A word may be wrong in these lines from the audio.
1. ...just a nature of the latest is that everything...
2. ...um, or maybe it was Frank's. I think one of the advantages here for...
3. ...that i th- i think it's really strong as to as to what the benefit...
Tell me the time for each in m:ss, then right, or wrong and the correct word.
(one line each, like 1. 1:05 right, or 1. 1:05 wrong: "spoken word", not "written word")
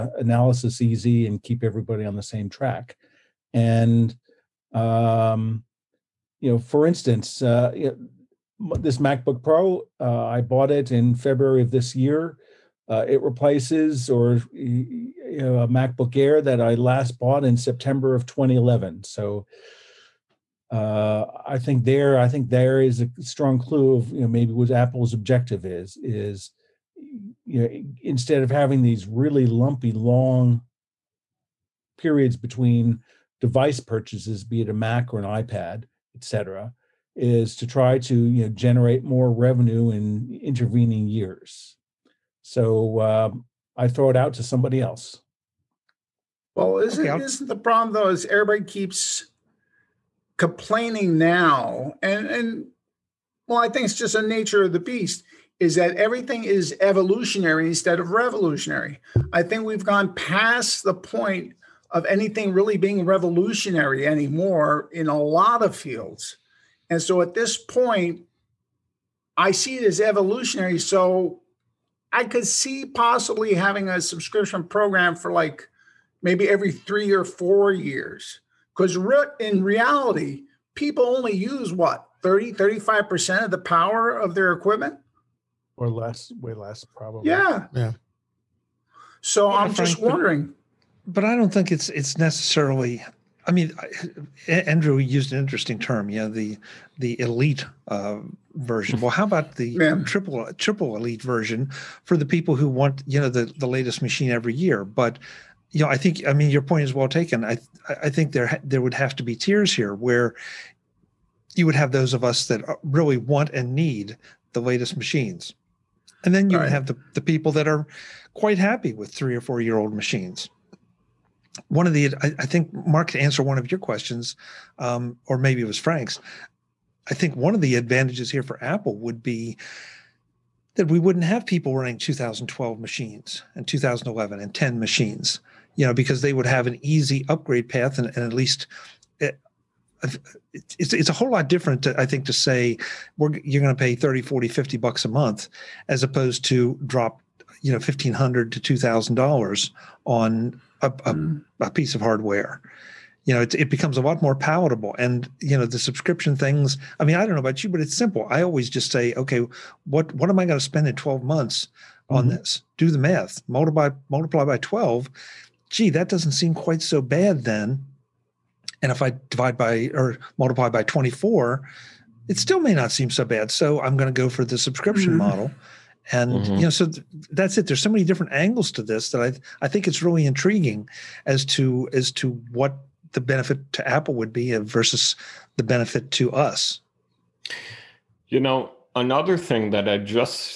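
1. 0:53 wrong: "beast", not "latest"
2. 2:04 right
3. 2:59 wrong: "intriguing", not "strong".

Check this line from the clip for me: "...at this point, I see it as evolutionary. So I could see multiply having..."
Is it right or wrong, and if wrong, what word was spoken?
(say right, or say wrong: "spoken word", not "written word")
wrong: "possibly", not "multiply".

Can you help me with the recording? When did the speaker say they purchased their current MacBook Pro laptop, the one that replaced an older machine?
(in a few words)
February.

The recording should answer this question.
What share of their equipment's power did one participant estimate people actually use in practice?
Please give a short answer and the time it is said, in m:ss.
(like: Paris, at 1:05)
30 to 35%, at 1:22.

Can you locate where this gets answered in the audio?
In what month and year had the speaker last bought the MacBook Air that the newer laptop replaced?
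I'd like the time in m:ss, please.
0:17.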